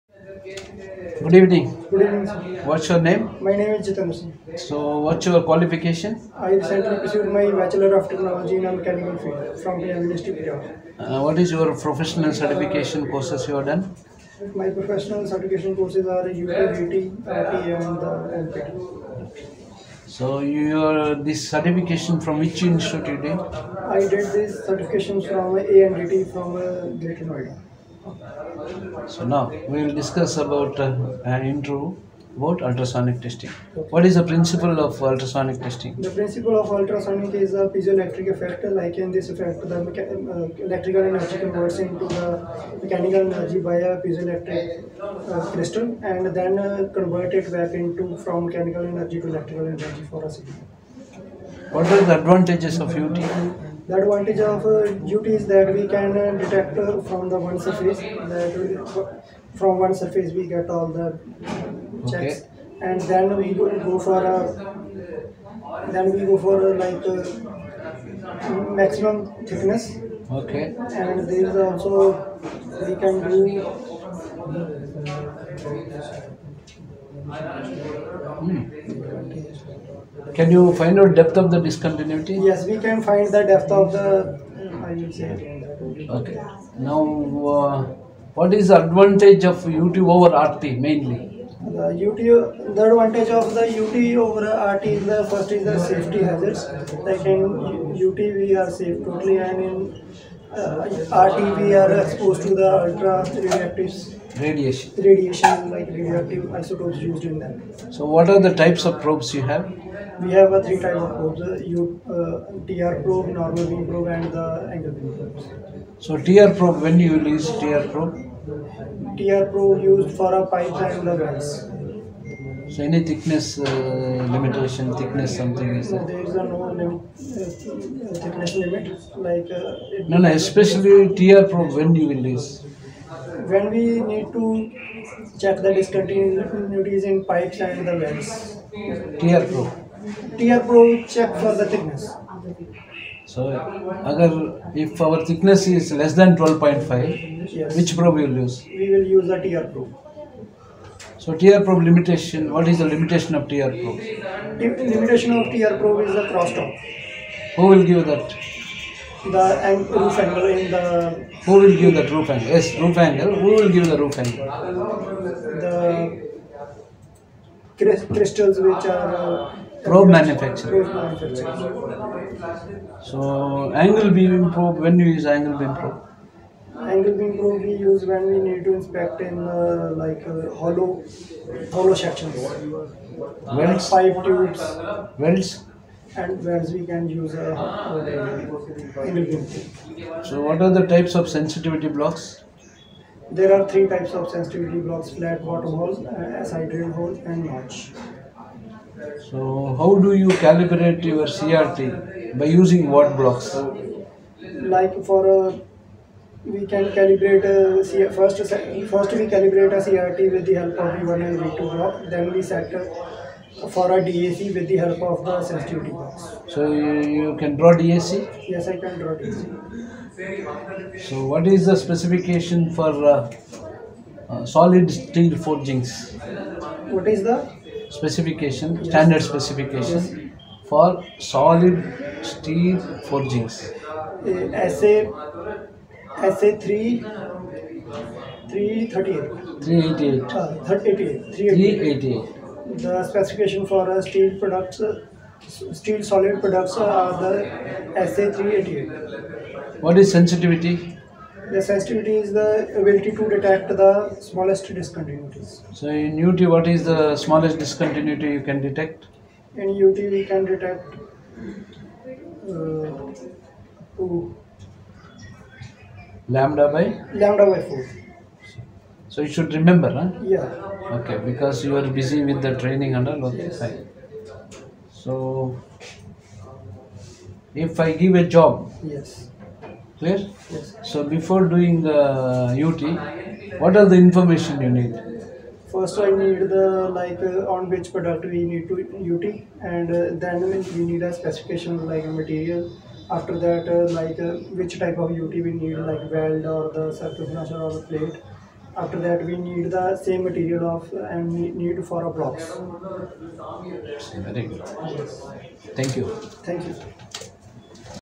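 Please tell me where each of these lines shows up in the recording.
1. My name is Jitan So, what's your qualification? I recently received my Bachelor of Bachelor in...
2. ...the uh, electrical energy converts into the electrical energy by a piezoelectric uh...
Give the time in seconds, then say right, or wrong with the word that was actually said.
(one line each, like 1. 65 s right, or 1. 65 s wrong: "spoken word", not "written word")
1. 3 s wrong: "Technology", not "Bachelor"
2. 39 s wrong: "mechanical", not "electrical".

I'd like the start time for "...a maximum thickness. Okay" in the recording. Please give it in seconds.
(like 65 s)
67 s.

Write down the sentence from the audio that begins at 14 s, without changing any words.
My professional certification courses are UPVT, RTA, and uh, LPT.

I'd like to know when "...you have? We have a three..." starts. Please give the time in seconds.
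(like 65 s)
109 s.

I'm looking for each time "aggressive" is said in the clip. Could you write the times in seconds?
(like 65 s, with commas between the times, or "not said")
not said.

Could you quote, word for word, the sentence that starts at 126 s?
There is a no limit, uh, thickness limit like...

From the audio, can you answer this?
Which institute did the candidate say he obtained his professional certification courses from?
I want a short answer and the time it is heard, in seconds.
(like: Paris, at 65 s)
ANDT, at 25 s.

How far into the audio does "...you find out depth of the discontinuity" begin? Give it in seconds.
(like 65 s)
80 s.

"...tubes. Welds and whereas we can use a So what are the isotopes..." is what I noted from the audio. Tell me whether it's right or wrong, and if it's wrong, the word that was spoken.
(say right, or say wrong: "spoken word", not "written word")
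wrong: "types", not "isotopes".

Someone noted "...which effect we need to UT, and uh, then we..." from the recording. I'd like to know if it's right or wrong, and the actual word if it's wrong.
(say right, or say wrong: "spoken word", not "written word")
wrong: "product", not "effect".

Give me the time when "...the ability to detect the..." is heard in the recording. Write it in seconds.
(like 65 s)
252 s.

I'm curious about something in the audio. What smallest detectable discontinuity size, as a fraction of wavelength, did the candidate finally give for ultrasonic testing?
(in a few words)
lambda/4.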